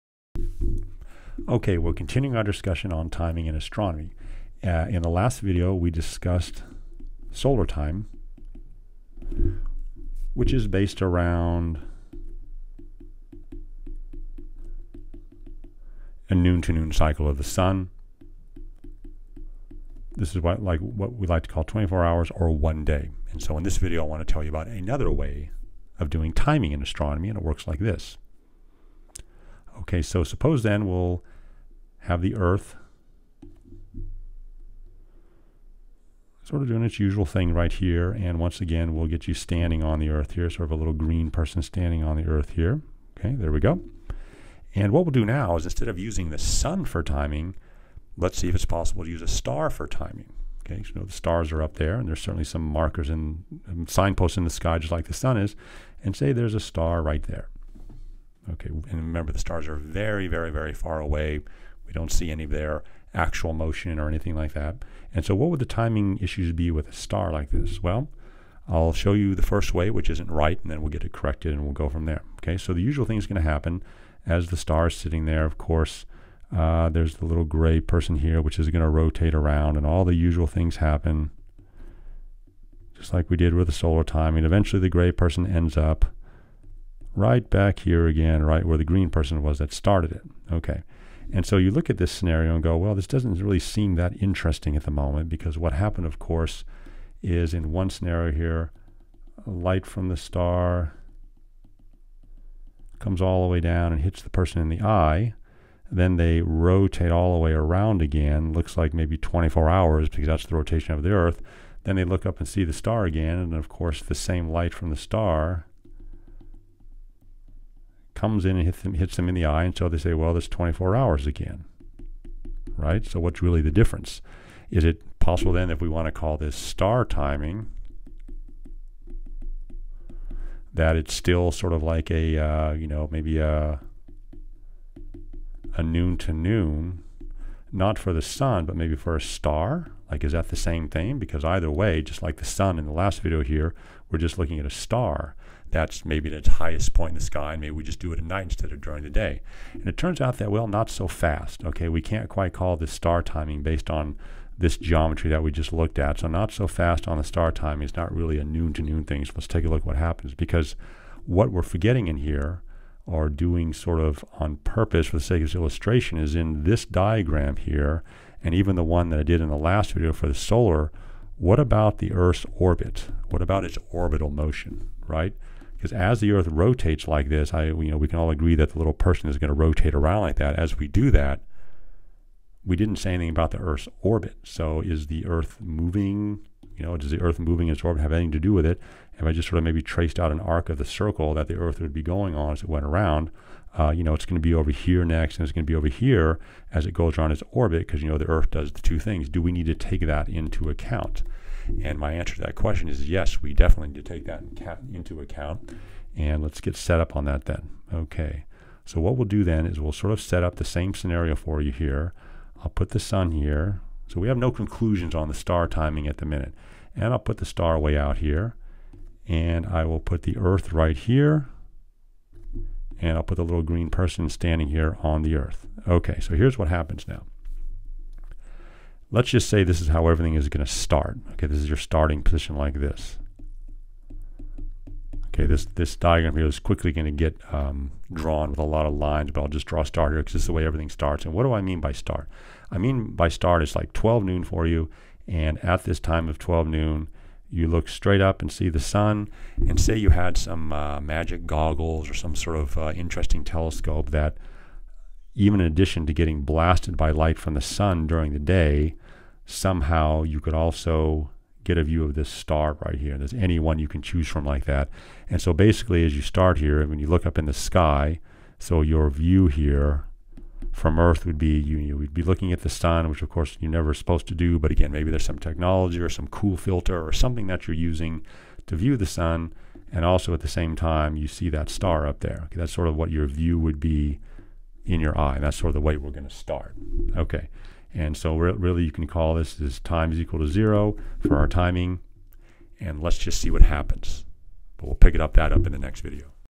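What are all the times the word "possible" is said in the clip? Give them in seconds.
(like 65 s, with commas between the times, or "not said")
48 s, 125 s.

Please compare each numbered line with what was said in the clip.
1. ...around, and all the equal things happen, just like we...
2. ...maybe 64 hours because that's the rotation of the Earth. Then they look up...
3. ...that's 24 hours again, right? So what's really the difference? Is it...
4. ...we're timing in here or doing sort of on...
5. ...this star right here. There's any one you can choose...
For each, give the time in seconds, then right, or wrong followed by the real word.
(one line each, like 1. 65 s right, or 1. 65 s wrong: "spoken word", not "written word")
1. 79 s wrong: "usual", not "equal"
2. 108 s wrong: "24", not "64"
3. 120 s right
4. 161 s wrong: "forgetting", not "timing"
5. 262 s right.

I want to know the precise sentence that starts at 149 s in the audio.
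And it turns out that, well, not so fast.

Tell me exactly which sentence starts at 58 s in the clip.
Okay, and remember the stars are very, very, very far away.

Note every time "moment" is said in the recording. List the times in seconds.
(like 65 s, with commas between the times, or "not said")
94 s.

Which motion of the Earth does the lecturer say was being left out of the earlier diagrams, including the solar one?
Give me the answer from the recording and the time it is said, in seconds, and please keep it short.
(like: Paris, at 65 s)
Its orbital motion, at 173 s.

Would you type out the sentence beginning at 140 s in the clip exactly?
Like, is that the same thing?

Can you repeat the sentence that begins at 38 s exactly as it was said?
And once again, we'll get you standing on the Earth here, sort of a little green person standing on the Earth here.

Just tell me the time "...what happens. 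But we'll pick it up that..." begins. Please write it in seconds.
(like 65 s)
293 s.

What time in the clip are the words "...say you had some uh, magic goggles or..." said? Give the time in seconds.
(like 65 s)
249 s.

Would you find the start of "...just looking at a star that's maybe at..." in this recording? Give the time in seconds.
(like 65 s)
144 s.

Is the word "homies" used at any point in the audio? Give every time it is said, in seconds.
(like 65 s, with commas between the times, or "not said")
not said.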